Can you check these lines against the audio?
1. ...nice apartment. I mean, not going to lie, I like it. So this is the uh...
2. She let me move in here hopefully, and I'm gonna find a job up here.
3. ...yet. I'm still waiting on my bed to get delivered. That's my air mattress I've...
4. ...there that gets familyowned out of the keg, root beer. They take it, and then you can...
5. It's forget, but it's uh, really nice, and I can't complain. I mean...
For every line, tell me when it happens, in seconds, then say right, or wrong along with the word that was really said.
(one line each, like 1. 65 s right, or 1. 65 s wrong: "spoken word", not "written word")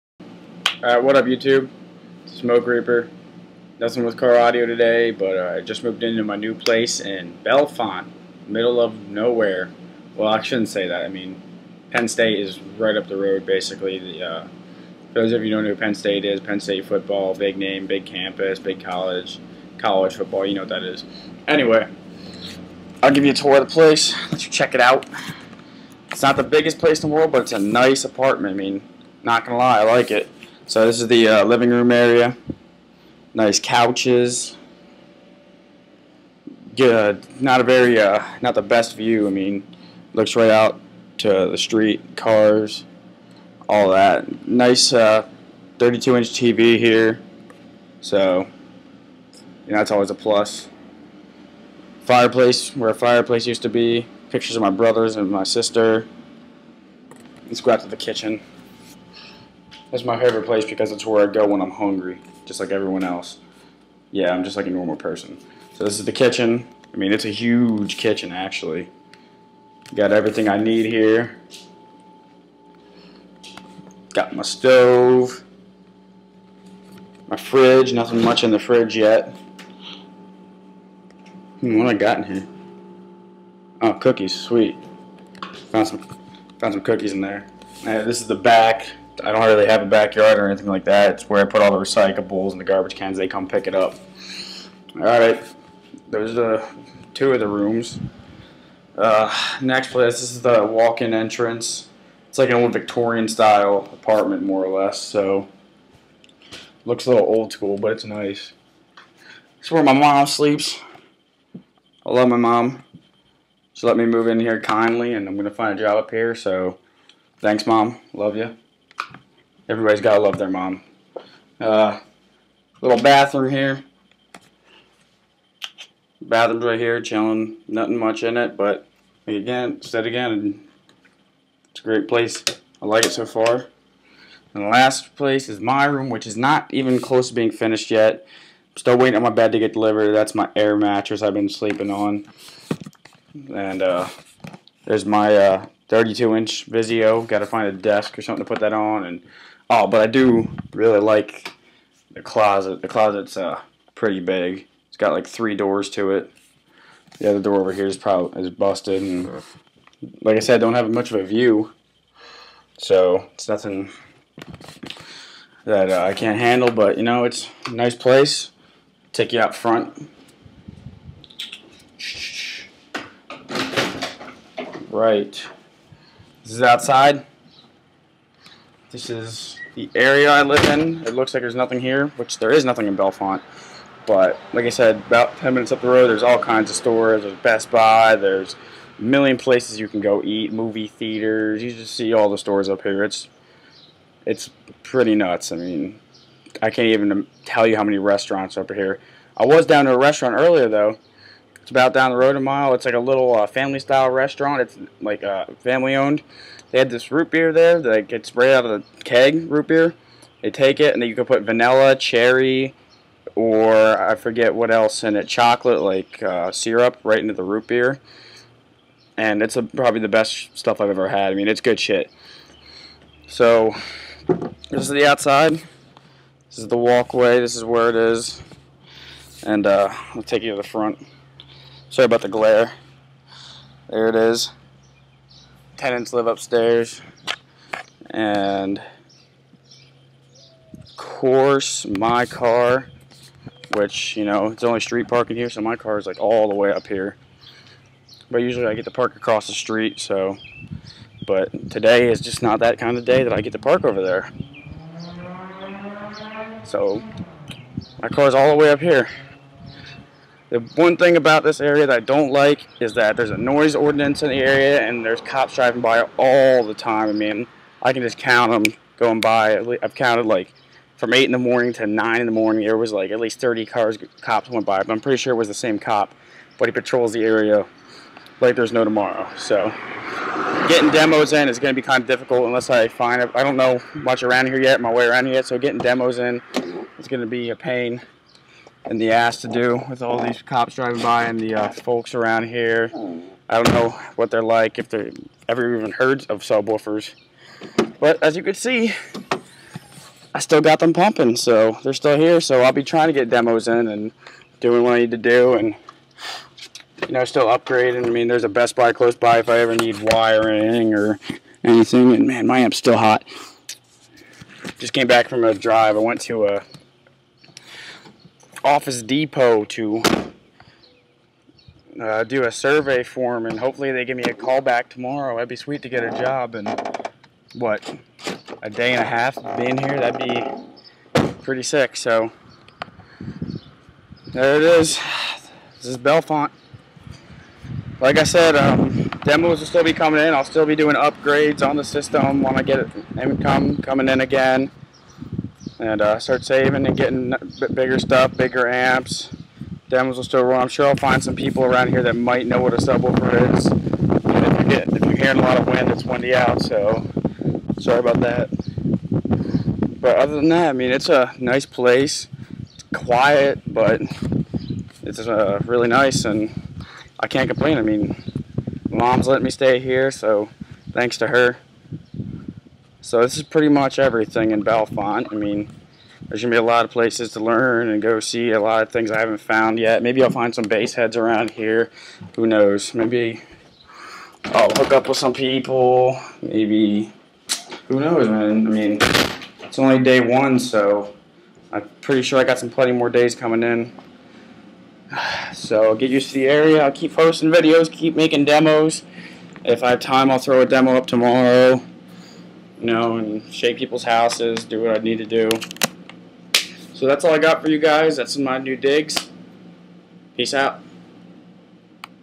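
1. 27 s right
2. 113 s wrong: "kindly", not "hopefully"
3. 137 s right
4. 207 s wrong: "sprayed", not "familyowned"
5. 362 s wrong: "quiet", not "forget".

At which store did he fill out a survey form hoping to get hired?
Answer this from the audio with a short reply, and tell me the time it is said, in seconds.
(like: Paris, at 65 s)
Office Depot, at 318 s.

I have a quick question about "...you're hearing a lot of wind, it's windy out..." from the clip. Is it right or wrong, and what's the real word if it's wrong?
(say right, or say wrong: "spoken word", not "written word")
right.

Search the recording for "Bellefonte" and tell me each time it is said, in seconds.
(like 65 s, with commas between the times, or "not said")
7 s, 182 s, 335 s, 374 s.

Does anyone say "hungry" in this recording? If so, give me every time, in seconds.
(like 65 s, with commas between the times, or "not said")
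61 s.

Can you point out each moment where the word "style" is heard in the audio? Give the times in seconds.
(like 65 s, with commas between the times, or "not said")
103 s, 203 s.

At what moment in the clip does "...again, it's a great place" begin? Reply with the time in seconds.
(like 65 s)
130 s.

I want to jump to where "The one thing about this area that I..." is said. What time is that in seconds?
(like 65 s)
260 s.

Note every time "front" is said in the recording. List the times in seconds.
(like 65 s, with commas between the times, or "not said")
169 s, 230 s.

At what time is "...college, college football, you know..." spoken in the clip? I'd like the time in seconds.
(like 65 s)
18 s.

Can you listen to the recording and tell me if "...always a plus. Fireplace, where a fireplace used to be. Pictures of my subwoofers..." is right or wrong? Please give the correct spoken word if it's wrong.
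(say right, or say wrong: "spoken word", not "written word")
wrong: "brothers", not "subwoofers".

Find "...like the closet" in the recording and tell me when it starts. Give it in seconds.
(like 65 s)
150 s.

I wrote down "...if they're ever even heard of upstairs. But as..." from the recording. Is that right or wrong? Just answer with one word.
wrong.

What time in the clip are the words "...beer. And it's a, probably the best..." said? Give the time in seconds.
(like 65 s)
217 s.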